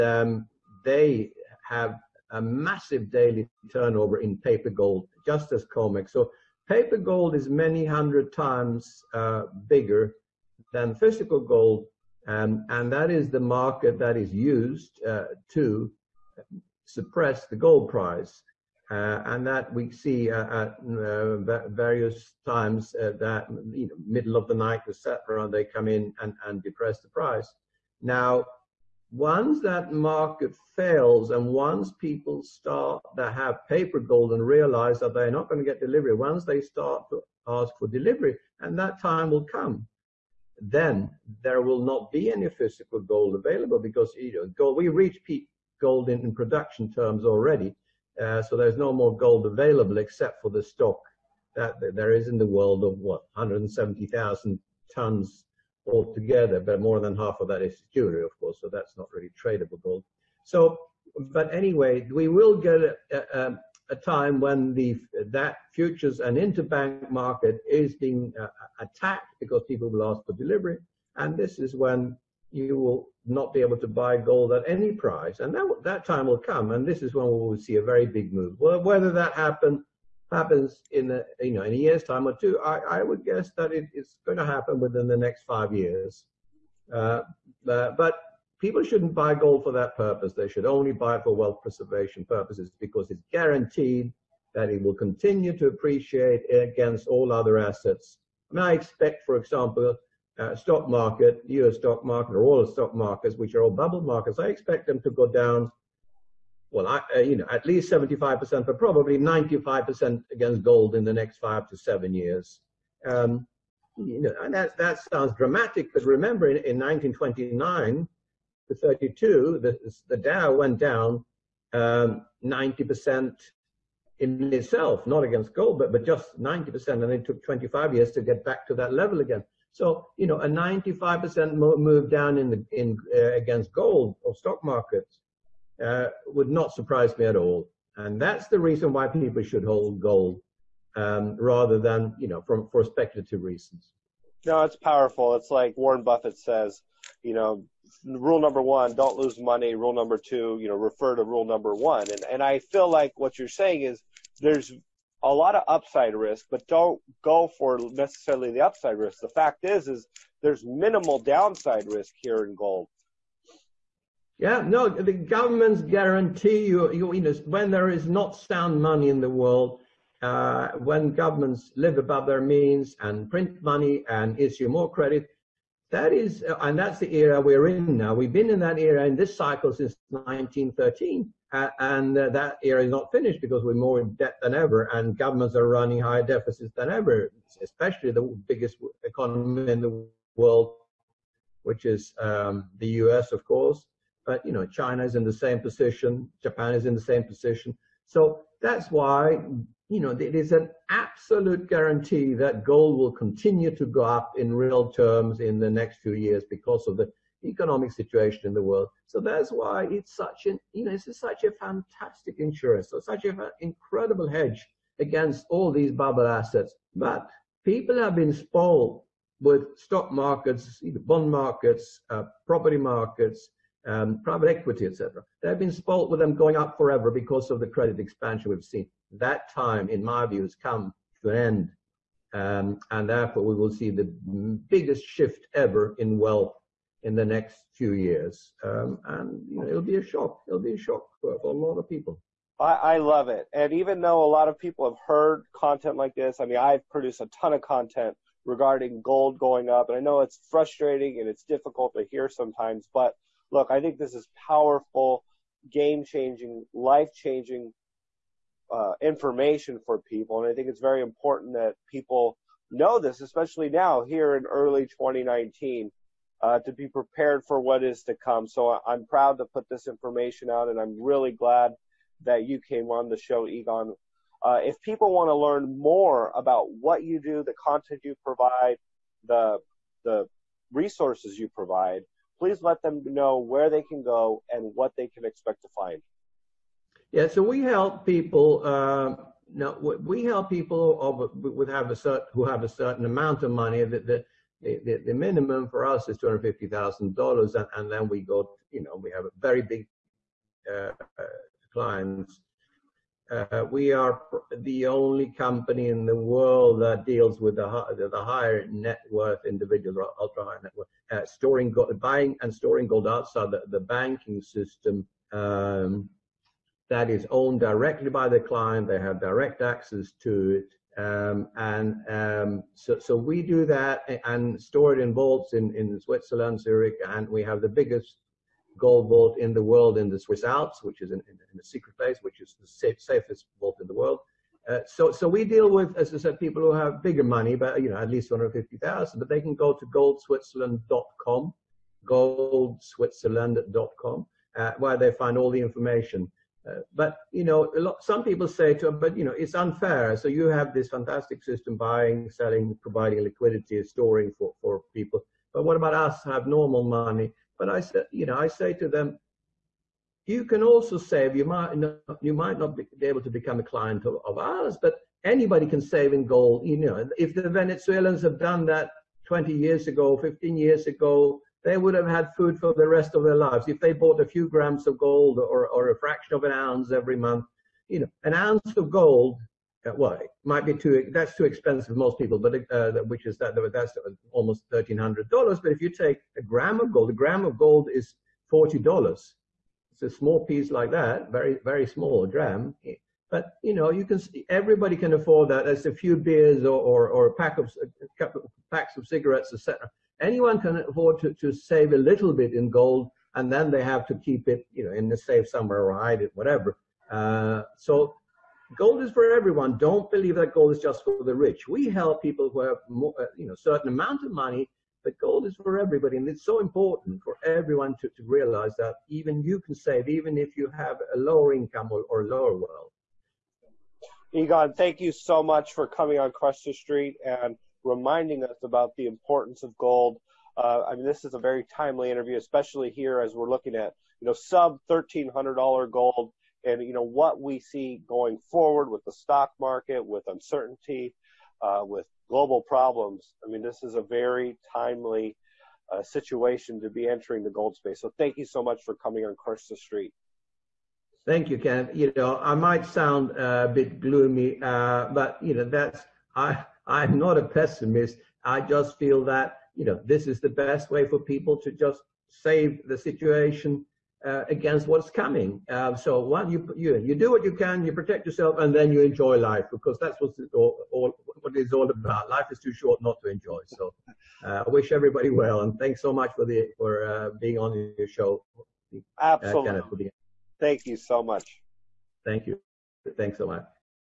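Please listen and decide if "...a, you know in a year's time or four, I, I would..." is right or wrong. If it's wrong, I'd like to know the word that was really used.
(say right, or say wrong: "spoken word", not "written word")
wrong: "two", not "four".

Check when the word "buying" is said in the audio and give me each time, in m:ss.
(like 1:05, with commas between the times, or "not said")
5:11, 5:51.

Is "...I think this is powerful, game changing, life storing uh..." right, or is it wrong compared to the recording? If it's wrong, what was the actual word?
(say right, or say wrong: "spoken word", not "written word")
wrong: "changing", not "storing".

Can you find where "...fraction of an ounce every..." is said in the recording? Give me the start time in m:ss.
6:15.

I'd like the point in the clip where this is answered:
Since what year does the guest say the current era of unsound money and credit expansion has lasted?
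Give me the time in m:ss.
3:00.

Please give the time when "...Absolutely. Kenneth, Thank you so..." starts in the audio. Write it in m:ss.
7:59.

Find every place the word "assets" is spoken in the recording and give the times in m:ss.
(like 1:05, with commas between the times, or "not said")
1:37, 3:36.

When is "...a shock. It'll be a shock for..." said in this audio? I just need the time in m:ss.
3:59.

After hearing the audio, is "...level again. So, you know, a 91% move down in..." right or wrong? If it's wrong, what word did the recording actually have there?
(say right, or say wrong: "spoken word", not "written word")
wrong: "95", not "91".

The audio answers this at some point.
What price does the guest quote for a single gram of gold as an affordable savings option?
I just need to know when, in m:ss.
6:28.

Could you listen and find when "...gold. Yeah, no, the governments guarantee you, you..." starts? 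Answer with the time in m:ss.
2:42.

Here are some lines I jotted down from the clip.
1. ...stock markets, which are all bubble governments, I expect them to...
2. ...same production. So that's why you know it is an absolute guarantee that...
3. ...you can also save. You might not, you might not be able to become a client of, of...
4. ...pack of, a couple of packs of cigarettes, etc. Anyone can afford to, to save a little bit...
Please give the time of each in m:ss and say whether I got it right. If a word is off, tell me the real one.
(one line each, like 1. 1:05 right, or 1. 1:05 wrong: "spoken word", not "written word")
1. 1:42 wrong: "markets", not "governments"
2. 3:16 wrong: "position", not "production"
3. 6:00 right
4. 6:37 right.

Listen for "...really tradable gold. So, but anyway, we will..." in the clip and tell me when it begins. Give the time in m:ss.
0:59.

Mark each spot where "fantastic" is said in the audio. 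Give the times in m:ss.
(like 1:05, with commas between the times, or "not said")
3:31, 5:50.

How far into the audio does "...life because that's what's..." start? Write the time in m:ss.
7:49.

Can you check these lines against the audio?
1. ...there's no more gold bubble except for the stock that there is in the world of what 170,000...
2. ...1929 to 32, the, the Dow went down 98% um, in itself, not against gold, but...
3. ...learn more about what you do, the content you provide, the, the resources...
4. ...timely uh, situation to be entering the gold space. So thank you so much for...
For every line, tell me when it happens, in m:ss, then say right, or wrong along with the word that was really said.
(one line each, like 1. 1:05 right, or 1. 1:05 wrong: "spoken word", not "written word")
1. 0:48 wrong: "available", not "bubble"
2. 1:56 wrong: "90", not "98"
3. 4:35 right
4. 7:24 right.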